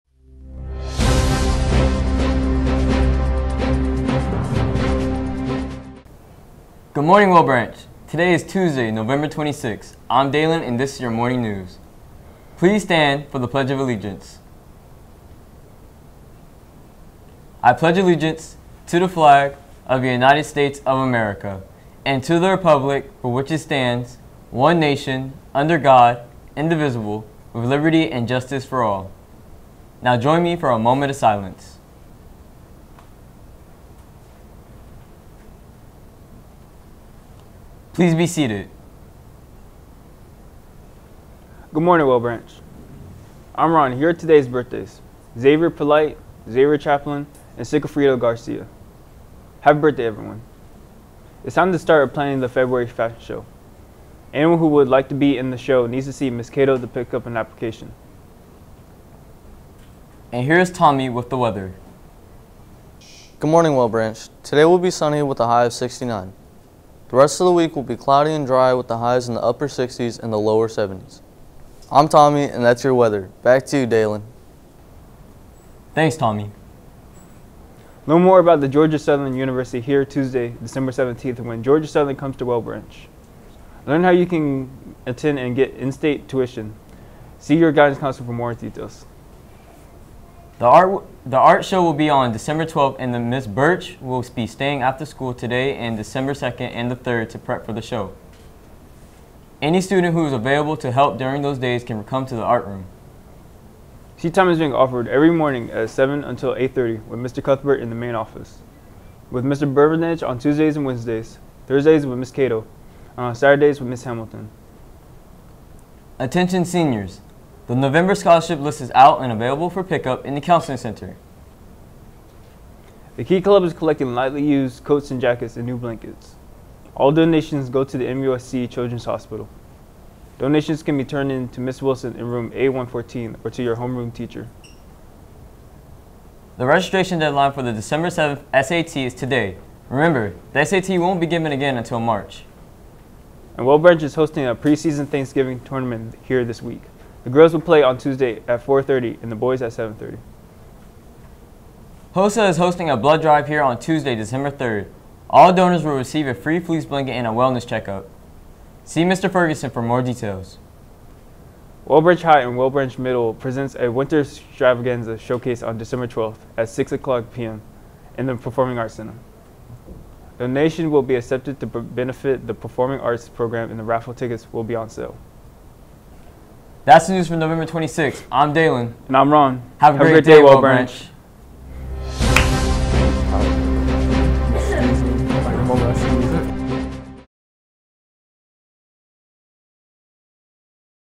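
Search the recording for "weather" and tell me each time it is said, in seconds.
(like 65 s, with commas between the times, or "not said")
61 s, 72 s.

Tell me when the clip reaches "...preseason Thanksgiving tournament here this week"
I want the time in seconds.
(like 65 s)
144 s.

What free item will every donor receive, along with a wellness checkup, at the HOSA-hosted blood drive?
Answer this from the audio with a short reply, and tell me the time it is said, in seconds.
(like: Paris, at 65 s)
Fleece blanket, at 156 s.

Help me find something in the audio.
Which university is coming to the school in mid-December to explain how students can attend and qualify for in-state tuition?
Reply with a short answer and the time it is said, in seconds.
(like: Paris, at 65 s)
Georgia Southern University, at 78 s.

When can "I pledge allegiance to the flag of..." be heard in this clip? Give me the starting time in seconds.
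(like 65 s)
17 s.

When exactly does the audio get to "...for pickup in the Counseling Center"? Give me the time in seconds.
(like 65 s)
119 s.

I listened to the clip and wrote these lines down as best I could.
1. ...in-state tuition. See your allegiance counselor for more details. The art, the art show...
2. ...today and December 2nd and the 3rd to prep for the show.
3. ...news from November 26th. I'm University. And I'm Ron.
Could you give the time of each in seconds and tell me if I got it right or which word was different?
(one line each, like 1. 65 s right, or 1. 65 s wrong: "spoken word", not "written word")
1. 85 s wrong: "guidance", not "allegiance"
2. 95 s right
3. 177 s wrong: "Dalen", not "University".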